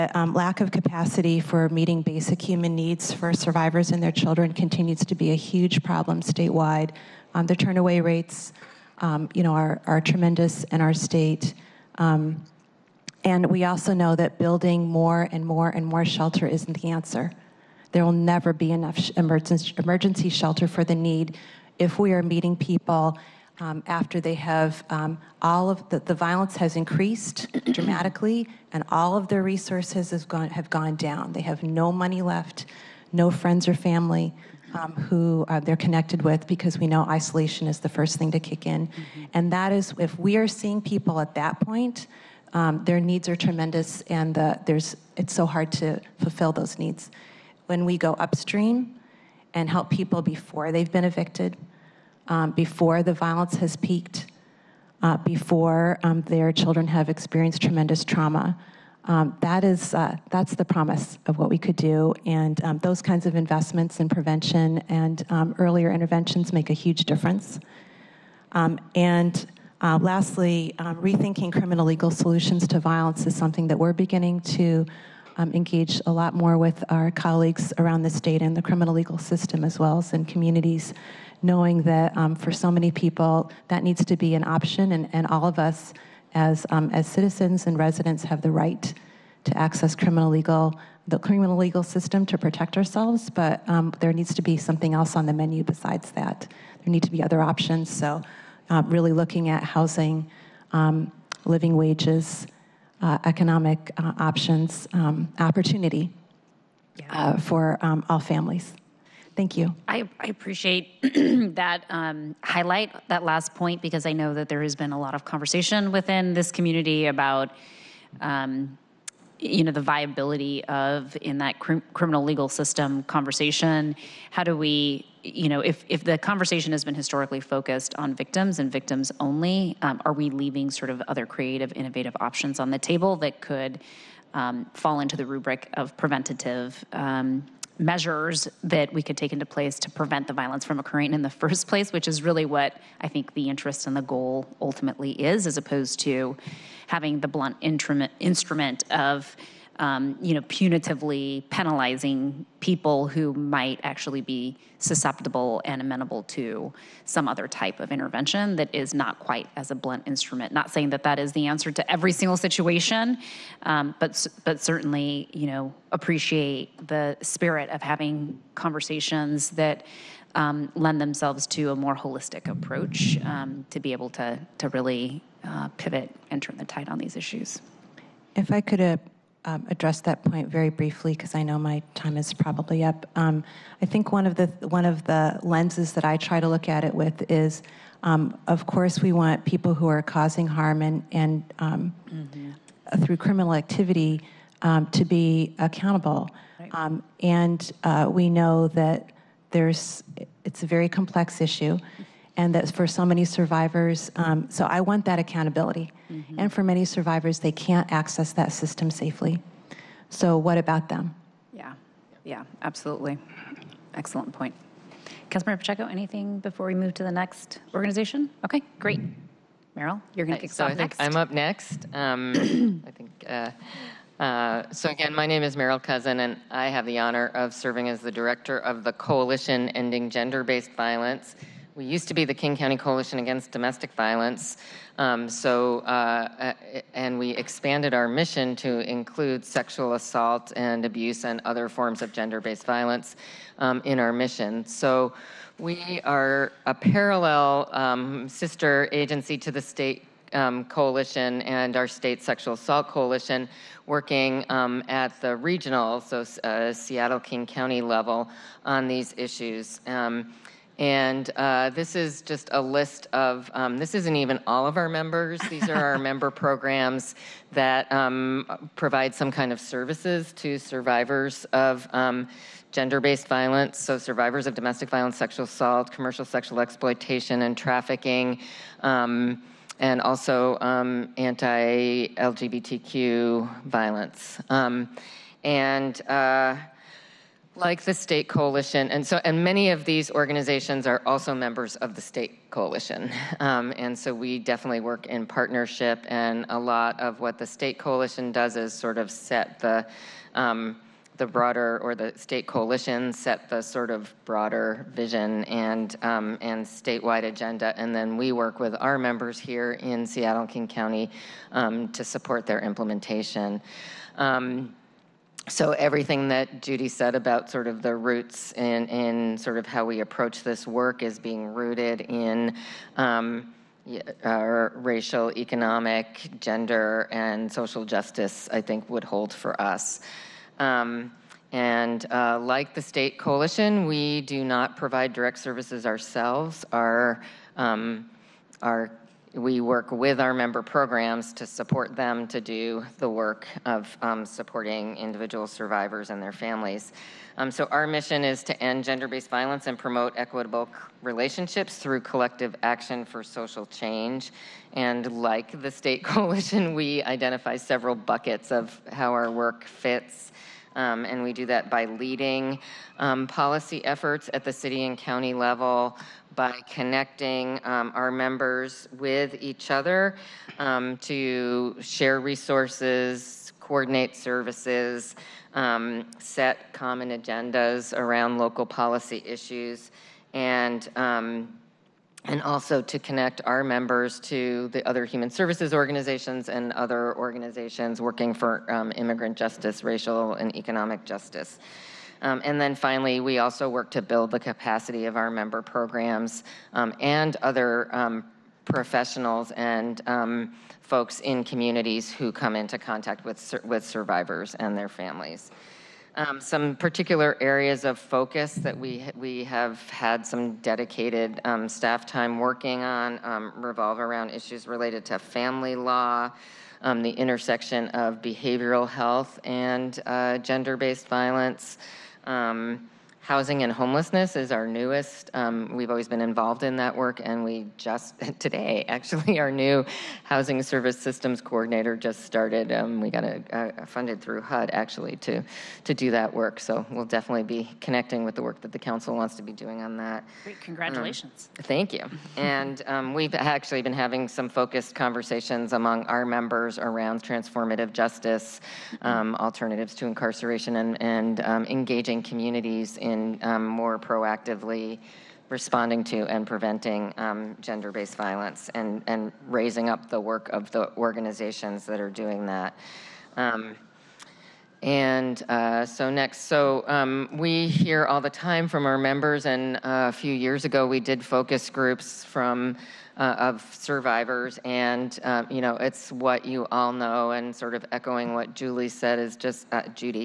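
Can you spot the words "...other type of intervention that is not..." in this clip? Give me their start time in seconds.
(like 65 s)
157 s.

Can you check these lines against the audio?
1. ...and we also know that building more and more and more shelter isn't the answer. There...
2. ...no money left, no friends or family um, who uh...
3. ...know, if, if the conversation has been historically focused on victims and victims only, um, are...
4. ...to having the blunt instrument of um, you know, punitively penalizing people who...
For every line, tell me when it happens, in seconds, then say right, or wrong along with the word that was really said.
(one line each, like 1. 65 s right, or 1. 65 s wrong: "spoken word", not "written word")
1. 13 s right
2. 31 s right
3. 125 s right
4. 145 s right.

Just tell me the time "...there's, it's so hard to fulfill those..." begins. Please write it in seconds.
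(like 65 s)
44 s.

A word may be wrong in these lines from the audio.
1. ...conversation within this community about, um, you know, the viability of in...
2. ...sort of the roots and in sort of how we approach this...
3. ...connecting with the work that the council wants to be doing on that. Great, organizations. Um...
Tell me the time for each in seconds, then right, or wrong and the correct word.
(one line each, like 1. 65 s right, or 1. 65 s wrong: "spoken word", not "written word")
1. 115 s right
2. 317 s right
3. 437 s wrong: "congratulations", not "organizations".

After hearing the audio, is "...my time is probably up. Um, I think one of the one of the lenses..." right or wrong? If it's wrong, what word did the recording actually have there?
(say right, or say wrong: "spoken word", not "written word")
right.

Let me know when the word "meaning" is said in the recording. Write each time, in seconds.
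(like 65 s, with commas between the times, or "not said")
not said.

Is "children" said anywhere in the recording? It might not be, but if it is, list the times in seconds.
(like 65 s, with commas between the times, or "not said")
4 s, 56 s.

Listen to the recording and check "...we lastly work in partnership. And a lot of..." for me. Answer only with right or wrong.
wrong.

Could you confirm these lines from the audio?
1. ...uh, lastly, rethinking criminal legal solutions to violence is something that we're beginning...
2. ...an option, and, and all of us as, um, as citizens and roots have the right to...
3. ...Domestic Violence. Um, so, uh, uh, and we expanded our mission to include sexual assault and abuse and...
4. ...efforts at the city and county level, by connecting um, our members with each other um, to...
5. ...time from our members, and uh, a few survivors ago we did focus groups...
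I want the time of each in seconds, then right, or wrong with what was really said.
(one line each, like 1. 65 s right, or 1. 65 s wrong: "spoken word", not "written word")
1. 69 s right
2. 84 s wrong: "residents", not "roots"
3. 233 s right
4. 363 s right
5. 468 s wrong: "years", not "survivors".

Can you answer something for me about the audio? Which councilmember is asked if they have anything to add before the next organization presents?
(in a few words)
Pacheco.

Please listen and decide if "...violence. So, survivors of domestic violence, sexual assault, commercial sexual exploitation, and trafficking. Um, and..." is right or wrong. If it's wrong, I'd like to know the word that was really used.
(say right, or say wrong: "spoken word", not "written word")
right.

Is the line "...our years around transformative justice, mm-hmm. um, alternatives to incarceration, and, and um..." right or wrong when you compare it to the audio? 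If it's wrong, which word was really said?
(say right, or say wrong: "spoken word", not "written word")
wrong: "members", not "years".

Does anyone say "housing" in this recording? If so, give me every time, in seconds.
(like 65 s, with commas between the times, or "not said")
99 s, 423 s, 430 s.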